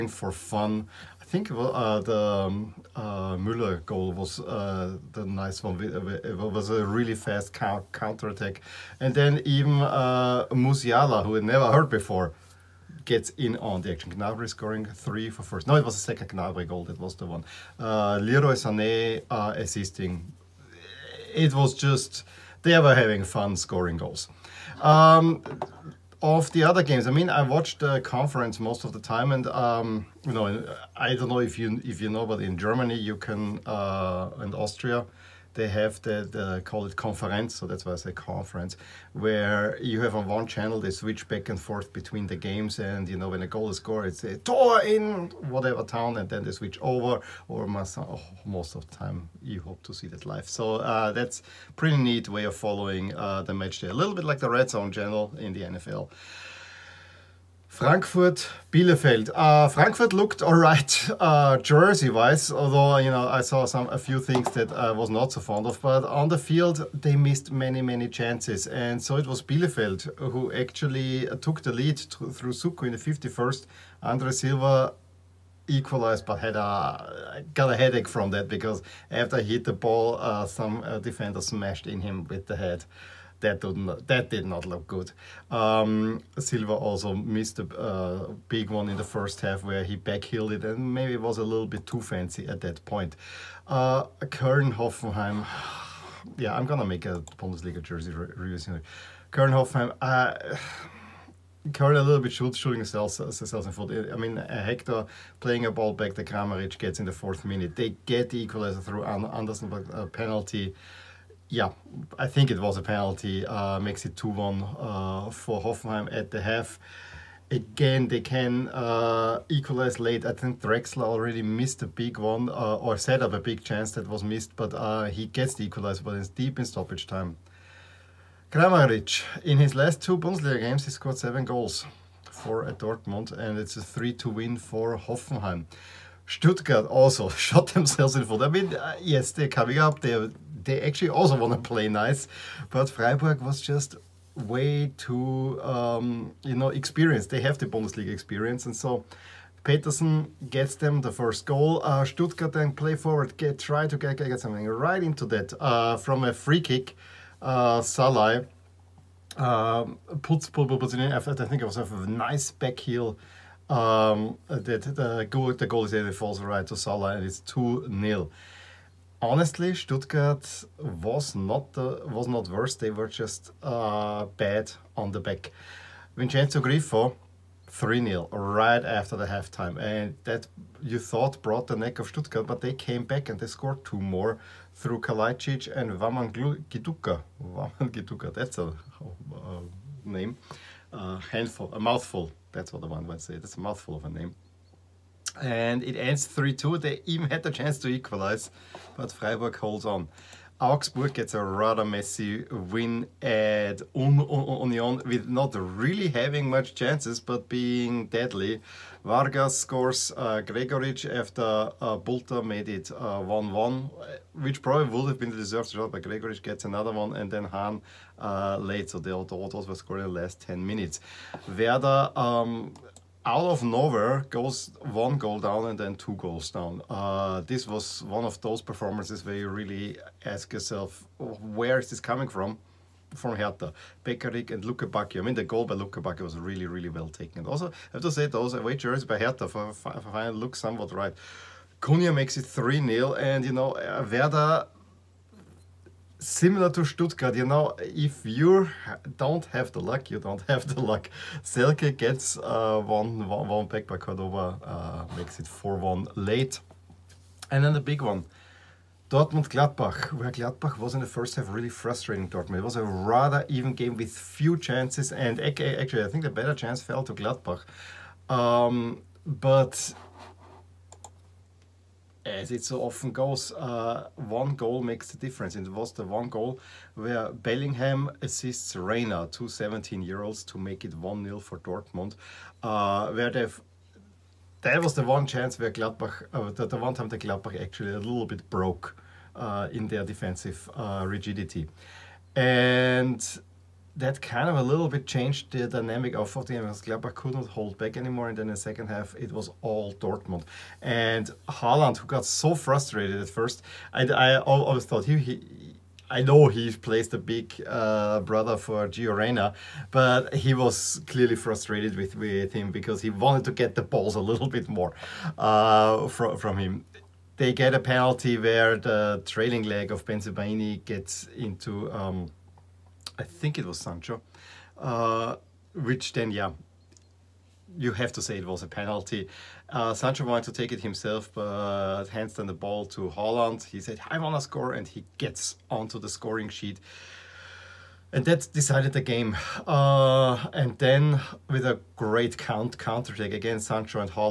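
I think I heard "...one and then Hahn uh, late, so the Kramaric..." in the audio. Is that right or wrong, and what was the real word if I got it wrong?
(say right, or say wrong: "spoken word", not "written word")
wrong: "Autos", not "Kramaric".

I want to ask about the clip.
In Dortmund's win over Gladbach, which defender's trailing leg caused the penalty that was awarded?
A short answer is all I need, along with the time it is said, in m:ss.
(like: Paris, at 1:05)
Bensebaini, at 5:20.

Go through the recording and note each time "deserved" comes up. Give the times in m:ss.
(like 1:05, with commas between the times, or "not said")
3:35.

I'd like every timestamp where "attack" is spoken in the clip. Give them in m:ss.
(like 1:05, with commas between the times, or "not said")
0:08.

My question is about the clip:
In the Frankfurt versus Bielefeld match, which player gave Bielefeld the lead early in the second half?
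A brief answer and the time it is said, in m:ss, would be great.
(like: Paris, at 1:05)
Soukou, at 1:12.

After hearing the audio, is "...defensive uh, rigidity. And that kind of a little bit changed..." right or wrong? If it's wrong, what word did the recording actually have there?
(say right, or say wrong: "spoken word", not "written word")
right.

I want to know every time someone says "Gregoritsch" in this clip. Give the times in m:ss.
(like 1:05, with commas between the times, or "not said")
3:30, 3:36.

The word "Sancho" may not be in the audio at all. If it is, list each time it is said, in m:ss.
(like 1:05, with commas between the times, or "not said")
5:23, 5:29, 5:43.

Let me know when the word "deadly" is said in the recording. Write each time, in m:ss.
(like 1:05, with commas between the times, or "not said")
3:28.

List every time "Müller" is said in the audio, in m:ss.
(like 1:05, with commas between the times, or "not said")
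0:03.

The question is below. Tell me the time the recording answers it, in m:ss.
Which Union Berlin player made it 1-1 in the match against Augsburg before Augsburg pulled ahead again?
3:31.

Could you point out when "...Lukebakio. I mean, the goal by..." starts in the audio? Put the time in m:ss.
3:54.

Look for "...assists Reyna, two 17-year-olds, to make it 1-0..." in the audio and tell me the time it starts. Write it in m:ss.
4:38.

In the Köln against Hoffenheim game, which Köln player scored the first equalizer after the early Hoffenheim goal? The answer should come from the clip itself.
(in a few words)
Andersson.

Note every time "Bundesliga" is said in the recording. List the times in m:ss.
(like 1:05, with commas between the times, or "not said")
1:37, 2:10, 2:27.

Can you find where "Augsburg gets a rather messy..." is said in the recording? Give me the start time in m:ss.
3:20.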